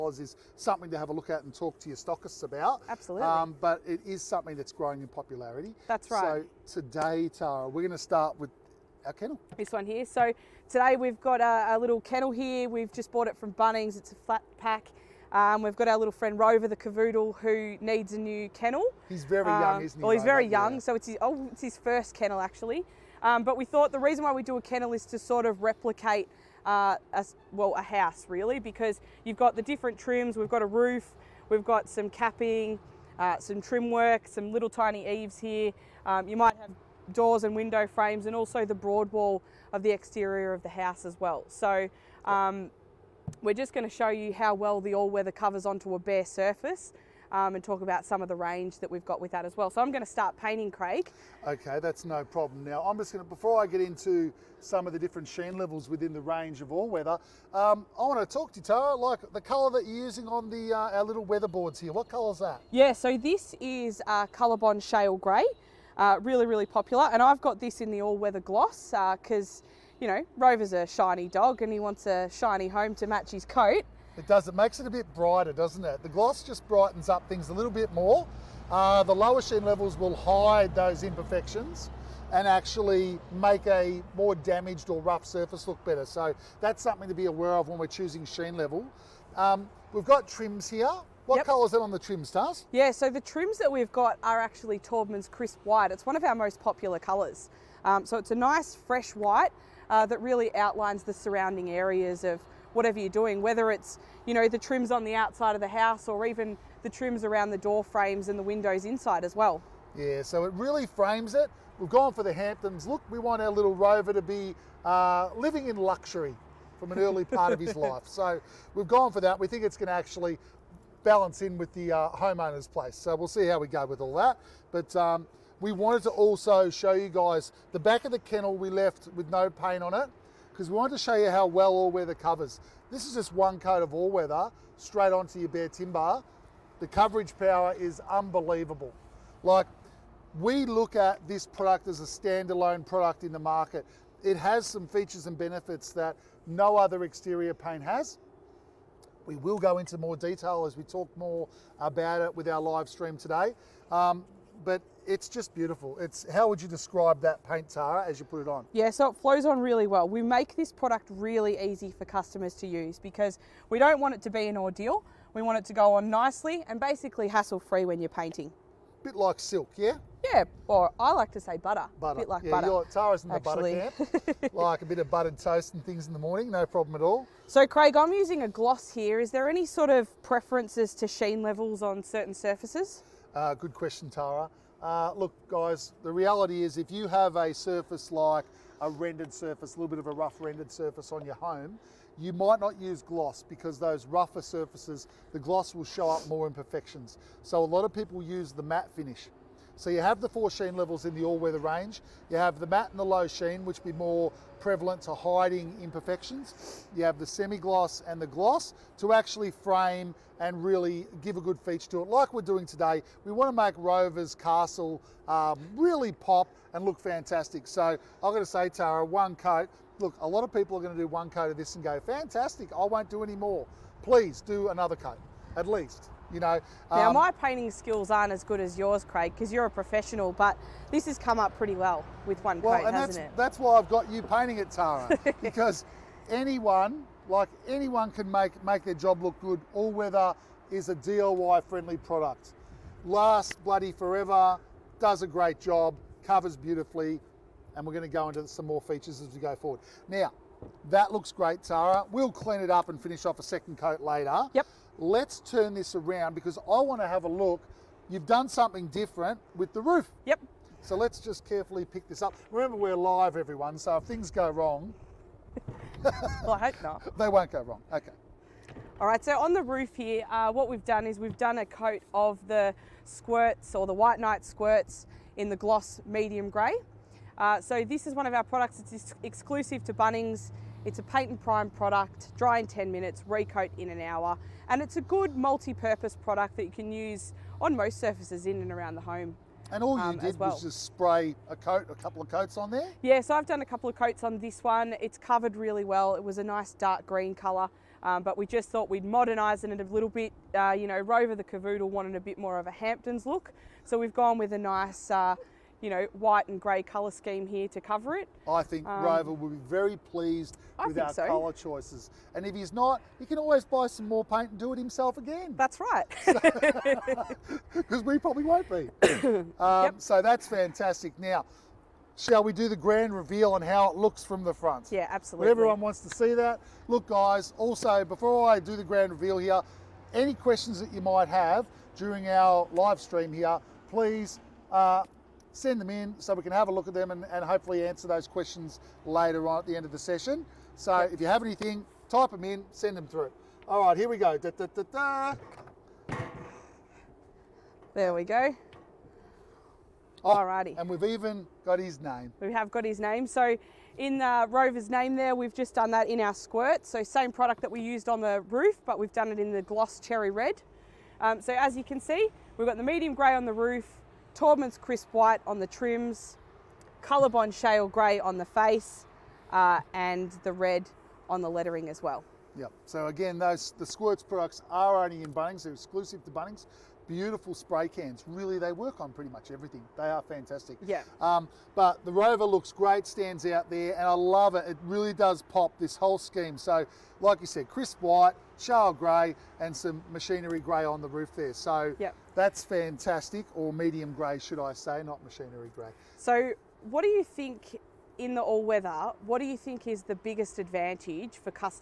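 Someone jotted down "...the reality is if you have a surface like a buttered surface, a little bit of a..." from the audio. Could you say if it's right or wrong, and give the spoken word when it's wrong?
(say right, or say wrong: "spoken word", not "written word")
wrong: "rendered", not "buttered".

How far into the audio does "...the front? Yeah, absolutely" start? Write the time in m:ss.
5:24.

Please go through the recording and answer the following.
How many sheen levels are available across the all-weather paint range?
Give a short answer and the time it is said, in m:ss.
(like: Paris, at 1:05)
4, at 3:20.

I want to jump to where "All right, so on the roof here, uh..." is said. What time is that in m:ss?
4:29.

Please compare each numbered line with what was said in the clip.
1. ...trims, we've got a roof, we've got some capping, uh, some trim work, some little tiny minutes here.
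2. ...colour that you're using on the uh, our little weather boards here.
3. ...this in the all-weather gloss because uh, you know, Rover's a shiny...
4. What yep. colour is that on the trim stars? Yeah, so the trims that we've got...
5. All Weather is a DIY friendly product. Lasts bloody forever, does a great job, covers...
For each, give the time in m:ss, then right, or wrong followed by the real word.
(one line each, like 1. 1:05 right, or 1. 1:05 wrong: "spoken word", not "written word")
1. 0:29 wrong: "eaves", not "minutes"
2. 0:59 right
3. 1:07 right
4. 1:31 right
5. 3:59 right.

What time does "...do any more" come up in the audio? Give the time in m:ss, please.
3:43.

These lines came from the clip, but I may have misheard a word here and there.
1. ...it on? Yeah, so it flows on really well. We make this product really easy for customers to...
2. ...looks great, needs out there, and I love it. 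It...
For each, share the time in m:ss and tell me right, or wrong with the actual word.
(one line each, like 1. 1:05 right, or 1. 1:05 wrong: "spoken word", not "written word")
1. 2:38 right
2. 6:22 wrong: "stands", not "needs".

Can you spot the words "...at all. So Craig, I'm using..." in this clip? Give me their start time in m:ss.
2:56.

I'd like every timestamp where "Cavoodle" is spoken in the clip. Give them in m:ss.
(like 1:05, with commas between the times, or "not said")
0:16, 5:01.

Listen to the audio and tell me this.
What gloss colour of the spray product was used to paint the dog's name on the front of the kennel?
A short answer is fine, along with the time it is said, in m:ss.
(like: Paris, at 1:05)
Cherry red, at 5:59.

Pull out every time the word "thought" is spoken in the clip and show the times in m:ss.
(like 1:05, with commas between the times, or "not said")
0:23, 4:58.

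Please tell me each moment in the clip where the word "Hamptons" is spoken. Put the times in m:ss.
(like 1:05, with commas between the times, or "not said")
1:52, 5:02.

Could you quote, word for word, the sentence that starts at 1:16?
The gloss just brightens up things a little bit more.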